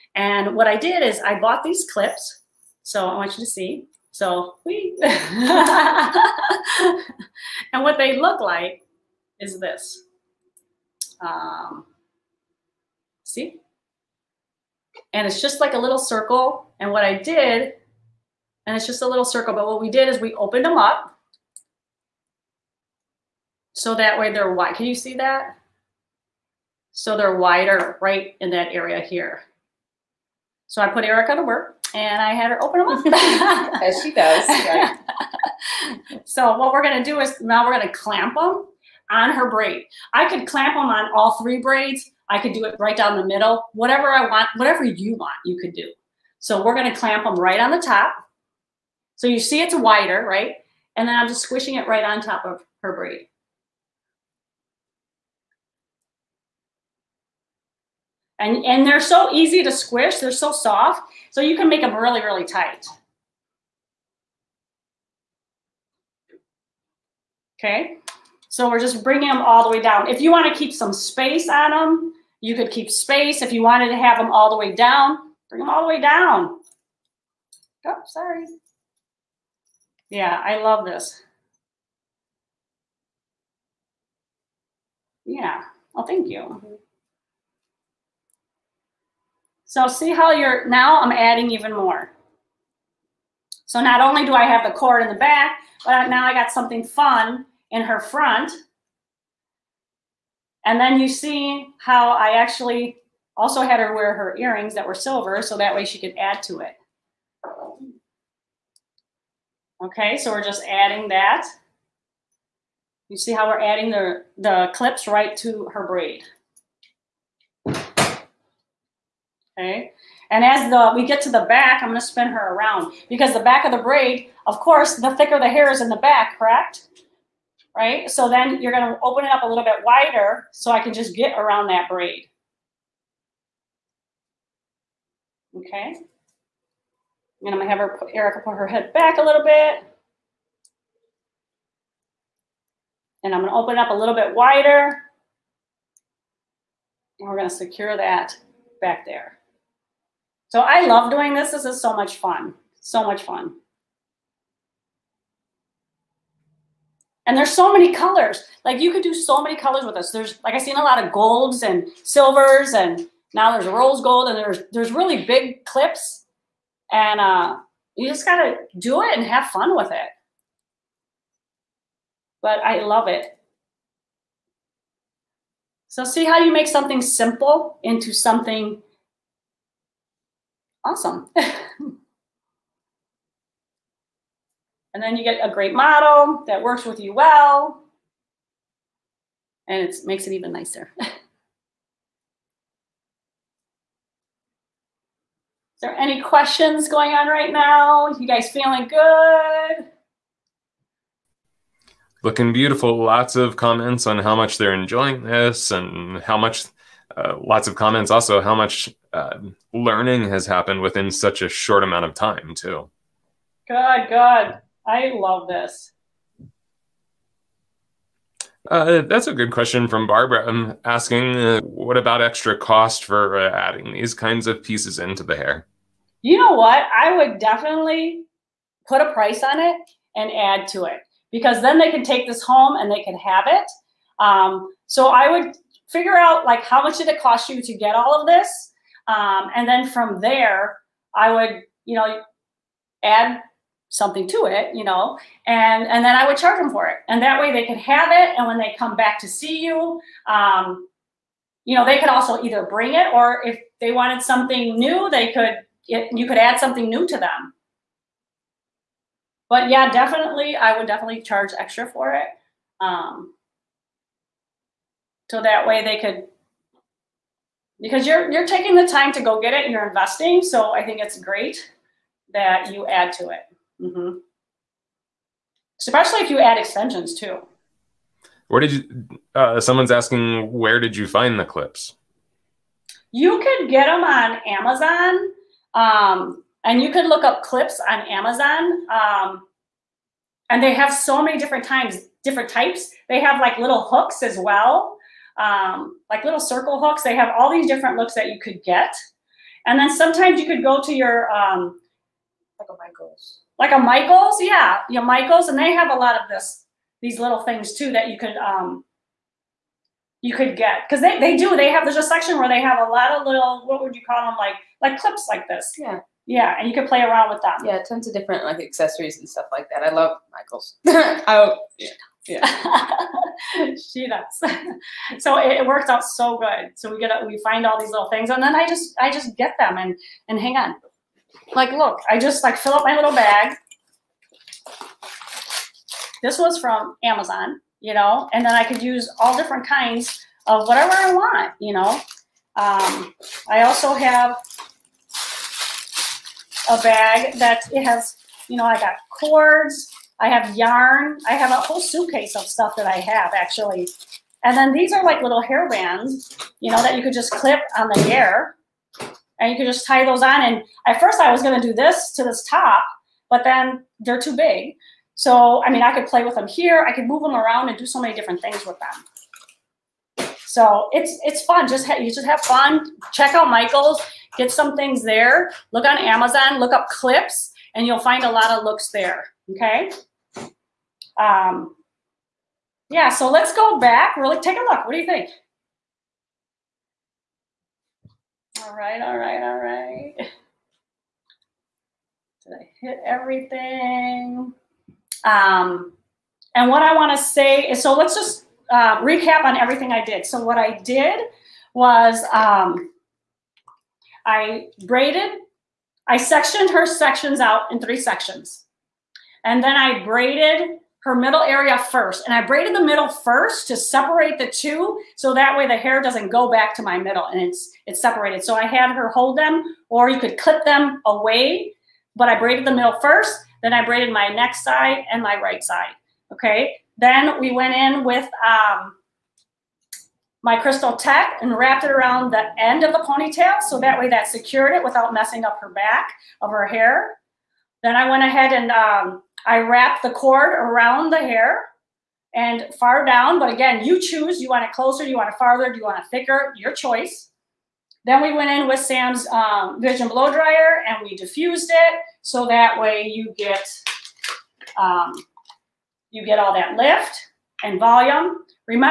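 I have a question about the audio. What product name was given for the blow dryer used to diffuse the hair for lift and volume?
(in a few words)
Vision Blow Dryer.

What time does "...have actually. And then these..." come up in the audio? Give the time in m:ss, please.
5:52.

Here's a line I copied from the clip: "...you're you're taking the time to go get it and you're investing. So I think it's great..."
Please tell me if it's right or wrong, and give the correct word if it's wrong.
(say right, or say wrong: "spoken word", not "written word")
right.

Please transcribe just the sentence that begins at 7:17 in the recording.
Then I went ahead and um, I wrap the cord around the hair and far down, but again, you choose.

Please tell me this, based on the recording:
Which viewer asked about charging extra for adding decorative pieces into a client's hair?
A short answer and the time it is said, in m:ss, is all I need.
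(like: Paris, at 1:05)
Barbara, at 3:39.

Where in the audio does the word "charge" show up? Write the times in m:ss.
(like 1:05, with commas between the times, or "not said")
4:06, 4:21.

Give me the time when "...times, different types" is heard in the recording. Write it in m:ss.
4:51.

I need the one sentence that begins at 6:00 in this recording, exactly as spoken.
And at first I was gonna do this to this top, but then they're too big.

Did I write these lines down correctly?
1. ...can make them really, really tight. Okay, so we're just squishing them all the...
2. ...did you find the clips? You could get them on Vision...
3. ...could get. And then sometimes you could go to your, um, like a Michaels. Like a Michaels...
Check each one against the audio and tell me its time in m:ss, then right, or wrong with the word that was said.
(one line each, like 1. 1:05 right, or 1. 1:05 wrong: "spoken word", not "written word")
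1. 1:01 wrong: "bringing", not "squishing"
2. 4:40 wrong: "Amazon", not "Vision"
3. 4:58 right.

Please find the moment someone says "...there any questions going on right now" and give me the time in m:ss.
3:15.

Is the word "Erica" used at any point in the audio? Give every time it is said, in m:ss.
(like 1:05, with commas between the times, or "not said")
0:31, 2:18.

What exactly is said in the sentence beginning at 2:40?
There's like I have seen a lot of golds and silvers and now there's rose gold and there's there's really big clips.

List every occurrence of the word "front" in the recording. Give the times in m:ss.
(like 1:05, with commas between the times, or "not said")
1:37.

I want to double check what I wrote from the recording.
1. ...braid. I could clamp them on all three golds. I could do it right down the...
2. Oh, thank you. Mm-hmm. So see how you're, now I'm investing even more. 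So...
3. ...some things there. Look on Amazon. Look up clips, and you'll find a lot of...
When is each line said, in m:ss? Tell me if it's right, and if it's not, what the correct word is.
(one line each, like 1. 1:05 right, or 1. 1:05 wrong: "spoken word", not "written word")
1. 0:39 wrong: "braids", not "golds"
2. 1:25 wrong: "adding", not "investing"
3. 6:14 right.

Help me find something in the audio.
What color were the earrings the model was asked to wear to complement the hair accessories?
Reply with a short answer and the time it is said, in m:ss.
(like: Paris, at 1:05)
Silver, at 1:44.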